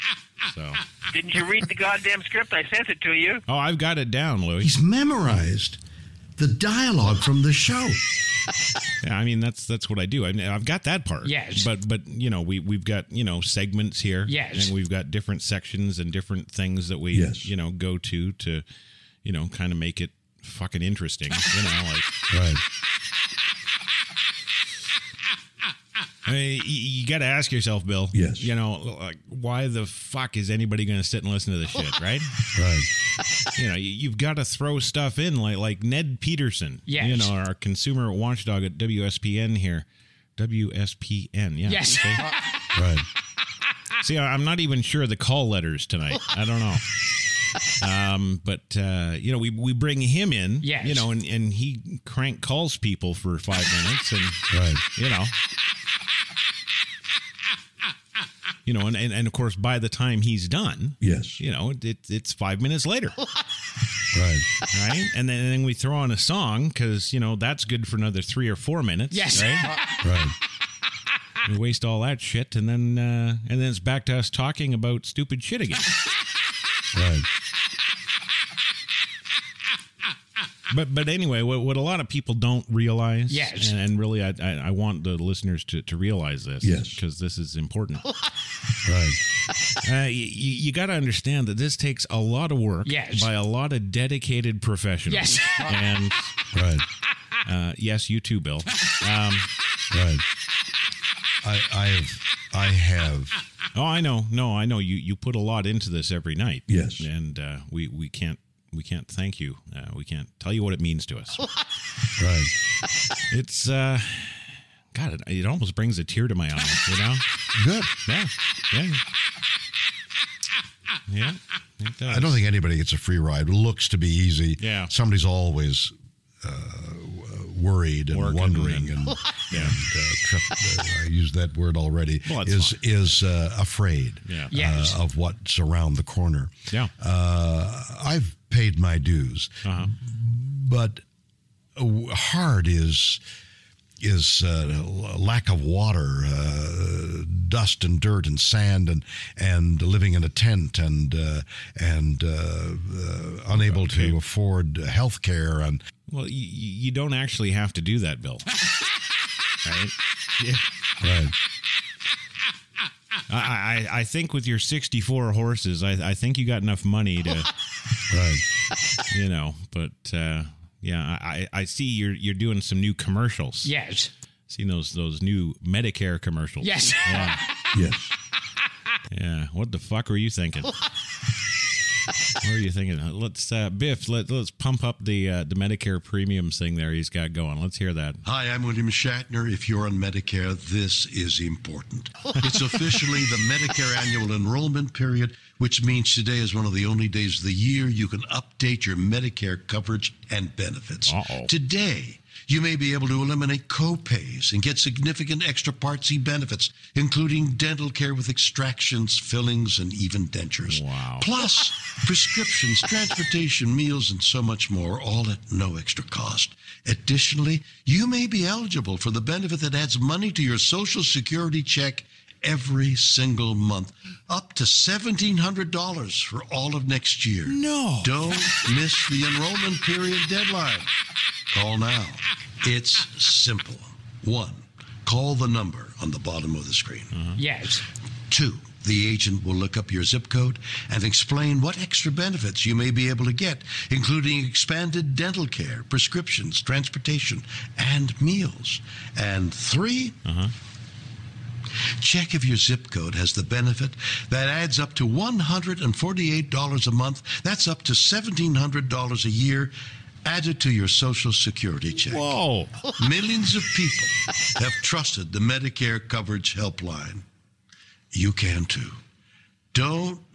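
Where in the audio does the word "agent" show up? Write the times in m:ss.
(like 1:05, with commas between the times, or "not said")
3:59.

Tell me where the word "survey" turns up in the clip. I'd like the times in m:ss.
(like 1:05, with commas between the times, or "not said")
not said.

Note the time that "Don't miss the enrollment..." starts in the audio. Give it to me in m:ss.
3:48.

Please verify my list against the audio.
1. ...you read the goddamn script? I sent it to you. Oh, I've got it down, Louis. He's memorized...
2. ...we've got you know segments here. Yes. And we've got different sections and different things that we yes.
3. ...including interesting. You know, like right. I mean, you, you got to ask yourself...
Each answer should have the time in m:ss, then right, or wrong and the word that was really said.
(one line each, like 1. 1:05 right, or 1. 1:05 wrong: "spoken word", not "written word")
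1. 0:01 right
2. 0:12 right
3. 0:20 wrong: "fucking", not "including".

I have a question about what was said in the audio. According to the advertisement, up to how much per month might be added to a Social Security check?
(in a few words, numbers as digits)
$148.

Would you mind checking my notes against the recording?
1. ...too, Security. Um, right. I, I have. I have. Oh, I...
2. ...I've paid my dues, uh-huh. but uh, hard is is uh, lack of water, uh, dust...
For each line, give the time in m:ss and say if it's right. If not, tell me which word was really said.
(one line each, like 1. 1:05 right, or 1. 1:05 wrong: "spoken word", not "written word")
1. 1:38 wrong: "Bill", not "Security"
2. 2:18 right.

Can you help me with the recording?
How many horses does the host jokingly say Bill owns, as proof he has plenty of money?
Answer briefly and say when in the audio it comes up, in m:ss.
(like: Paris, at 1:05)
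64, at 2:44.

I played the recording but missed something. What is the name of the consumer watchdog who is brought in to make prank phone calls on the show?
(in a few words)
Ned Peterson.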